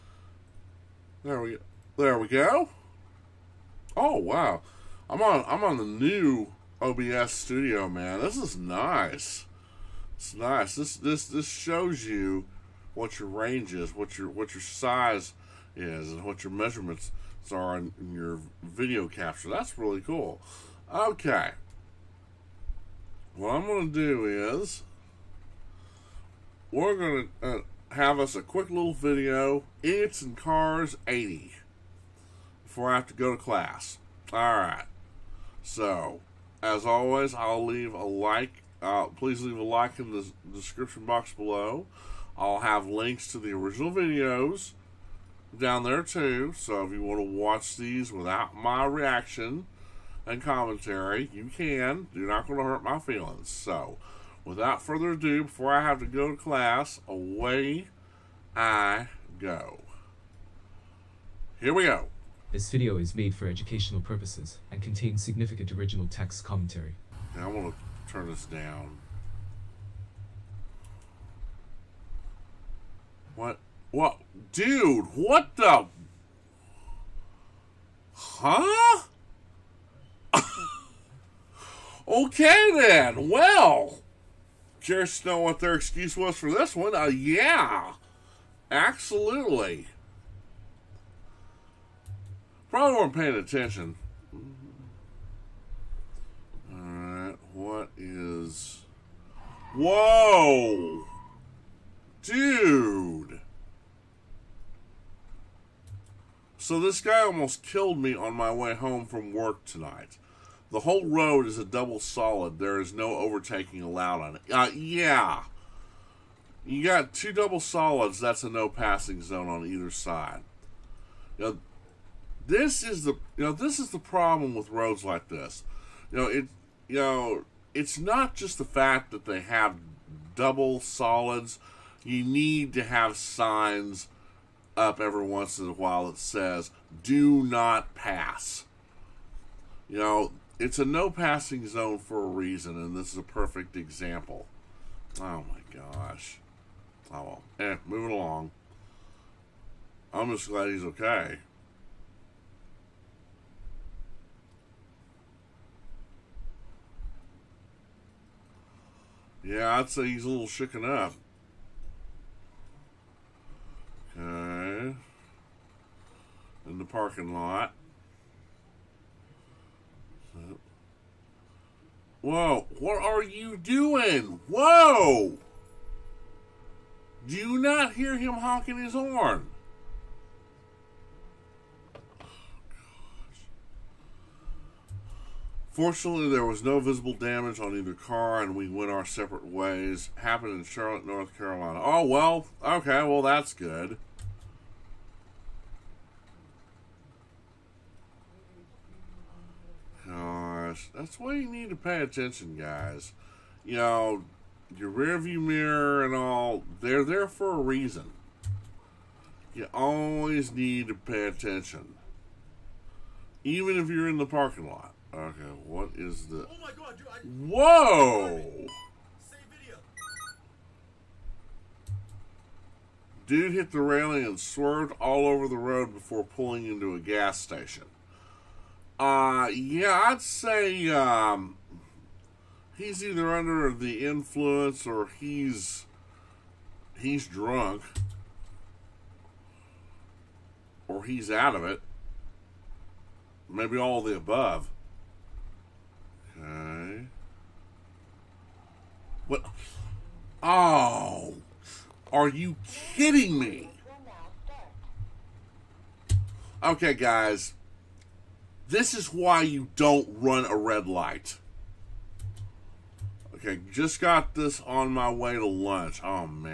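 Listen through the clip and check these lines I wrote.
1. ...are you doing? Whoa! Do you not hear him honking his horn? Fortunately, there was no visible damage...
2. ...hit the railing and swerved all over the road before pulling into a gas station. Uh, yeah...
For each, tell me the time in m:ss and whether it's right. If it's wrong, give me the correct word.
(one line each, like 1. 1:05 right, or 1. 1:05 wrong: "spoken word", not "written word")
1. 2:53 right
2. 3:43 right.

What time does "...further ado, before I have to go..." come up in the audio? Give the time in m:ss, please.
0:54.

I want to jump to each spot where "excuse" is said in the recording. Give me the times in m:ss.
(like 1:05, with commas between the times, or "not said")
1:25.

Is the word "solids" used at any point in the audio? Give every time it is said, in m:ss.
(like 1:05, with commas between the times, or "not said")
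1:51, 1:57, 2:10.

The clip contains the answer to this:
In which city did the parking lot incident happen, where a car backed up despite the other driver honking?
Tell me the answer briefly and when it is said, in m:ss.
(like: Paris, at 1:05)
Charlotte, North Carolina, at 3:10.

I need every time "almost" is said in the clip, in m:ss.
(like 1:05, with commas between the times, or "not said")
1:47.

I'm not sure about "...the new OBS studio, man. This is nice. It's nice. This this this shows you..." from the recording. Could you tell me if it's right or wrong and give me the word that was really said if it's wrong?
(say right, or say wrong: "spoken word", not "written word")
right.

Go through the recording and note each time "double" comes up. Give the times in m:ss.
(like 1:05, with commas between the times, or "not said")
1:51, 1:57, 2:10.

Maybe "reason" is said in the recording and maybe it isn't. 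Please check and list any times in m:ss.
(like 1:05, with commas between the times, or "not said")
2:22, 3:27.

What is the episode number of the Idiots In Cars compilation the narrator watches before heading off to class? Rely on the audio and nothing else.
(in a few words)
80.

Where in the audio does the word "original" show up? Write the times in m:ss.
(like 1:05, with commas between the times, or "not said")
0:43, 1:05.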